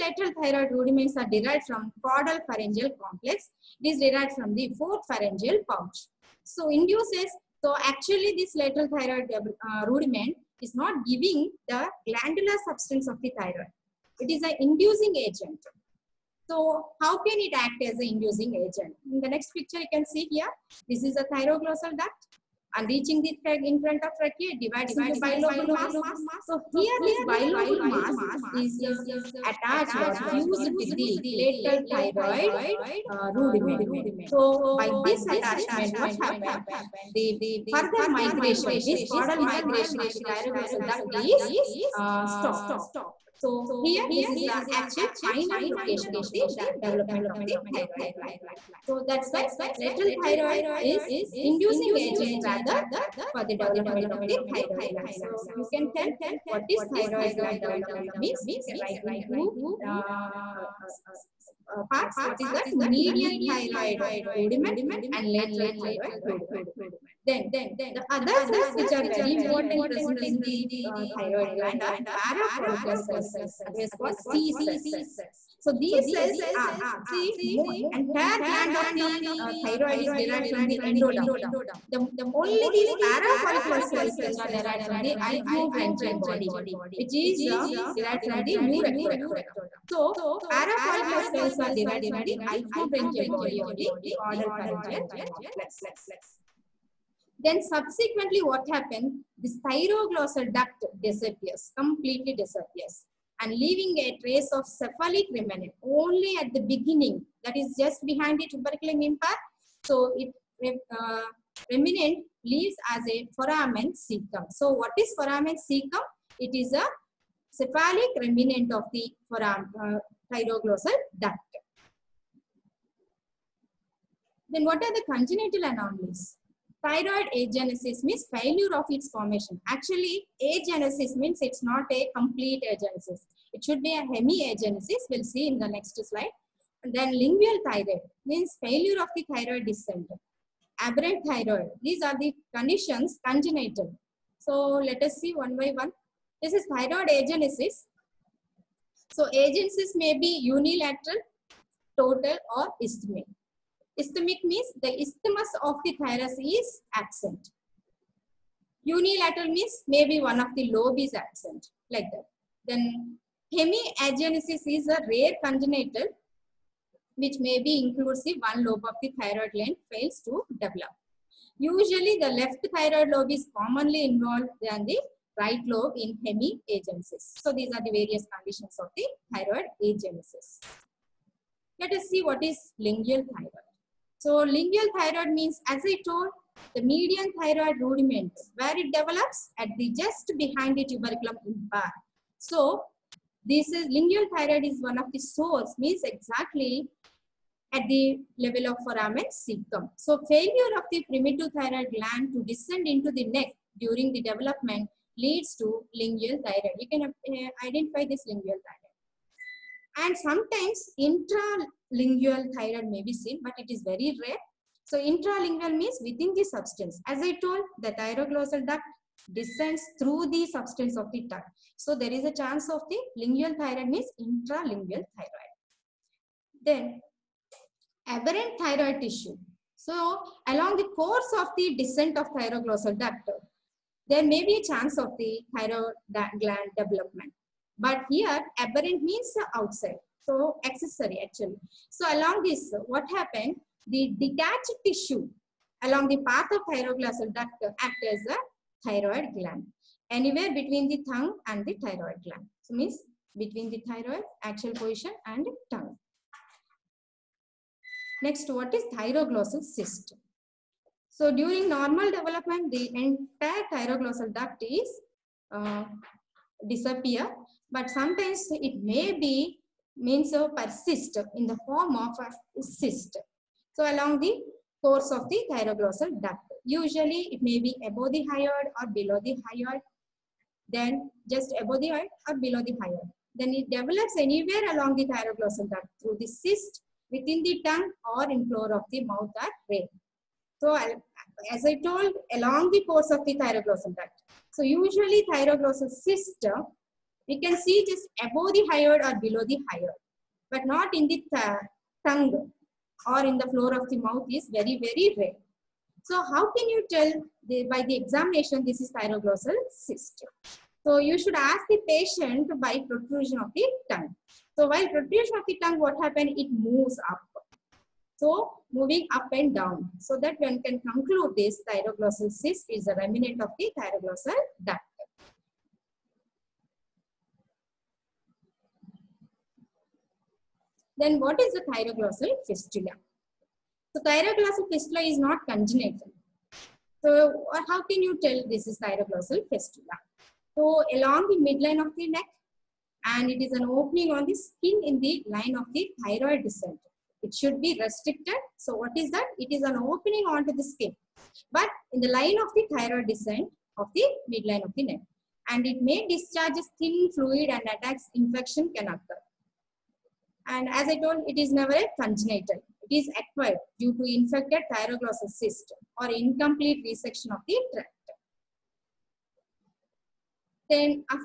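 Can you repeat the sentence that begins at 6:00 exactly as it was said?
And as I told, it is never congenital.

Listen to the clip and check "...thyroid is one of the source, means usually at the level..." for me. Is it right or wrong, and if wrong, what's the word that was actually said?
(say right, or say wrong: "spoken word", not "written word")
wrong: "exactly", not "usually".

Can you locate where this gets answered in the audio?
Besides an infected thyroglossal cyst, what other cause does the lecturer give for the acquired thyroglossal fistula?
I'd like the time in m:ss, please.
6:06.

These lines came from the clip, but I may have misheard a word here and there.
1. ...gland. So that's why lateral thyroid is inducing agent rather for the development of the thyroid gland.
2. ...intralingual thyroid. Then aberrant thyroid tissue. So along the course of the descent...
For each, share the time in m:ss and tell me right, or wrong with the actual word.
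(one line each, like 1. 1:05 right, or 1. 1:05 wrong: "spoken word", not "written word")
1. 0:48 right
2. 3:44 right.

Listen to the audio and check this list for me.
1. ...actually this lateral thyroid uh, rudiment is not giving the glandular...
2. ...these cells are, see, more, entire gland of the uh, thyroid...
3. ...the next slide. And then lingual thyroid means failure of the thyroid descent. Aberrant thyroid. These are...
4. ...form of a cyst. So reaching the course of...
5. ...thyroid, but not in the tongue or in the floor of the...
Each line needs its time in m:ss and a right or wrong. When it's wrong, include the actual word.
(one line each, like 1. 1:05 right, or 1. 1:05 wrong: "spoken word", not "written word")
1. 0:07 right
2. 1:15 right
3. 2:15 right
4. 4:31 wrong: "along", not "reaching"
5. 4:59 wrong: "hyoid", not "thyroid".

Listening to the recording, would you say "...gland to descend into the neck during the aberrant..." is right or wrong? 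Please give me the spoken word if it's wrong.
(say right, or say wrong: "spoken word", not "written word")
wrong: "development", not "aberrant".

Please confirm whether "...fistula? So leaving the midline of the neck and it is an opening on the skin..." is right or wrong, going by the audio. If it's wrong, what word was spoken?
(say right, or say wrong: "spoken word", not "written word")
wrong: "along", not "leaving".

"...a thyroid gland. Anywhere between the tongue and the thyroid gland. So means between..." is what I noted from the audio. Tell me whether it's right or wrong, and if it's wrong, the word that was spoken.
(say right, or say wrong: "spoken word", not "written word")
right.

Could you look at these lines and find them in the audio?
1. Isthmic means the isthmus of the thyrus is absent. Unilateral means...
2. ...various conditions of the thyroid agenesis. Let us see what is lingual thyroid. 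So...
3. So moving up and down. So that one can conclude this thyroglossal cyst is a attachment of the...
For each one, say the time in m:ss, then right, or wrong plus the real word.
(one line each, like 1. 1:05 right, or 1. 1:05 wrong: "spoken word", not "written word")
1. 2:33 right
2. 2:57 right
3. 5:18 wrong: "remnant", not "attachment".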